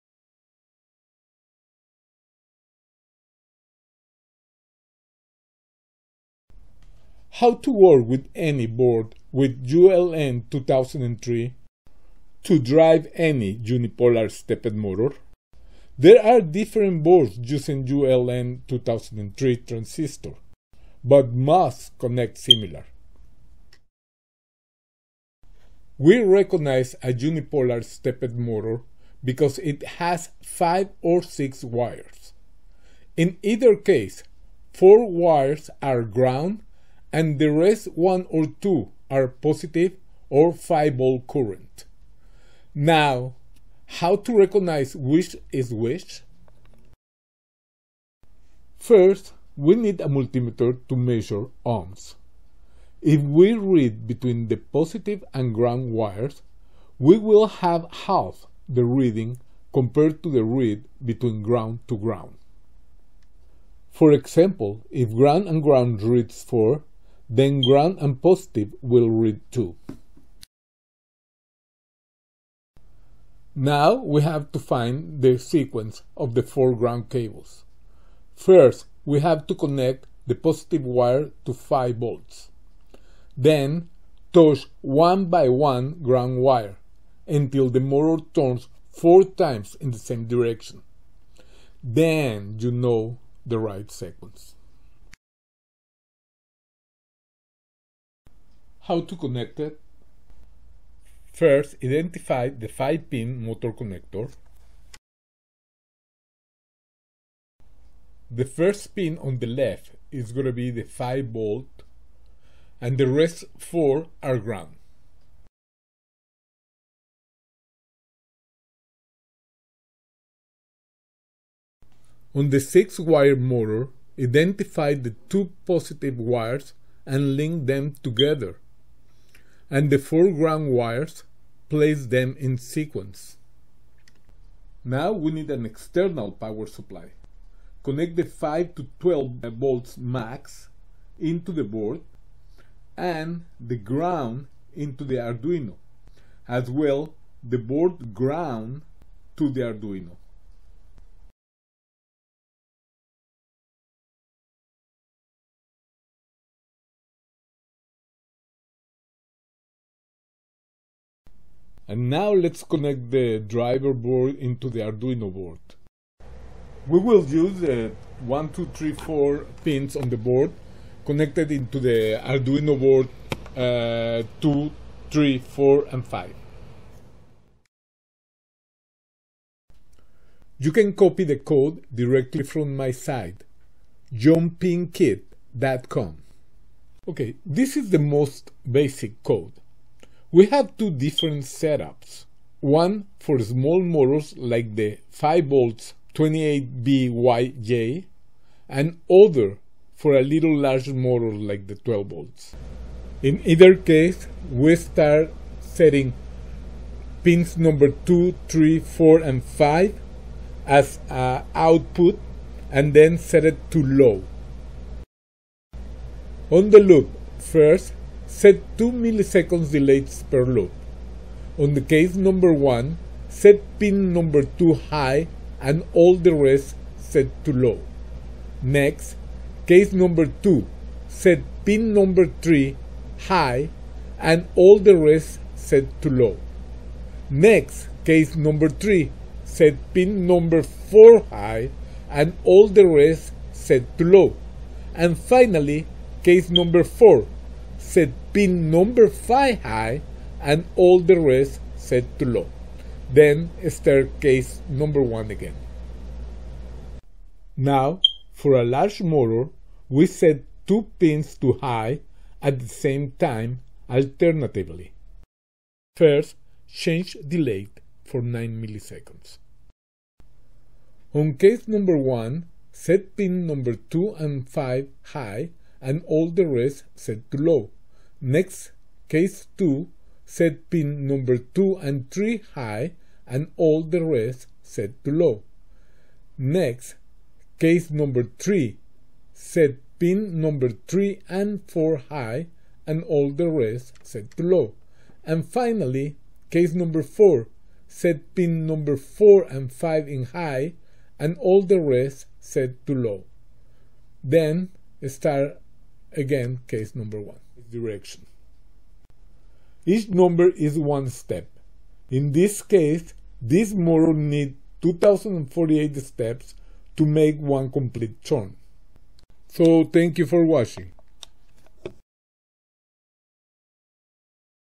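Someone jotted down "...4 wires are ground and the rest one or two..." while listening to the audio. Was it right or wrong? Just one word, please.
right.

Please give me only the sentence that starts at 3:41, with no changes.
On the case number 1, set pin number 2 high and all the rest set to low.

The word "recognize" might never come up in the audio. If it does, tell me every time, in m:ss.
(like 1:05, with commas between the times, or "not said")
0:26, 0:44.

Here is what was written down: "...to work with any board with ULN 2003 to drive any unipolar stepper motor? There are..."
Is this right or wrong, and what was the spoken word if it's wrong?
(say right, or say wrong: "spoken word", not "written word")
right.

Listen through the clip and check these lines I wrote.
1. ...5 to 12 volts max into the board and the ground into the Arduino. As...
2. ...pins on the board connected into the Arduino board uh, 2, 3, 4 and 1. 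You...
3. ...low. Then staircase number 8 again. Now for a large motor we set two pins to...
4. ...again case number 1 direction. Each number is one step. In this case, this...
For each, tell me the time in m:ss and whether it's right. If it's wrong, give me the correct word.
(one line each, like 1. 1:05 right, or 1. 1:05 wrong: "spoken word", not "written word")
1. 2:18 right
2. 2:49 wrong: "5", not "1"
3. 4:12 wrong: "1", not "8"
4. 5:06 right.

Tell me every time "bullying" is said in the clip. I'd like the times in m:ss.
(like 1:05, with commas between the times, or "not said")
not said.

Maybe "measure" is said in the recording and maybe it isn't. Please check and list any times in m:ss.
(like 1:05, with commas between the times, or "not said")
0:50.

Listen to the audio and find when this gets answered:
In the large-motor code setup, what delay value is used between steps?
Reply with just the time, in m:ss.
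4:28.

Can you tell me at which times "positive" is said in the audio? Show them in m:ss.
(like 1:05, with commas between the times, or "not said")
0:39, 0:54, 1:08, 1:20, 2:05.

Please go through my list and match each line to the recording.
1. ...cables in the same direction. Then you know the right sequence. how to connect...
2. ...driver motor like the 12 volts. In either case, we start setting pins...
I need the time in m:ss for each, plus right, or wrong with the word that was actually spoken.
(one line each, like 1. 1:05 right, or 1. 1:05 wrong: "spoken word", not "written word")
1. 1:29 wrong: "times", not "cables"
2. 3:20 wrong: "larger", not "driver".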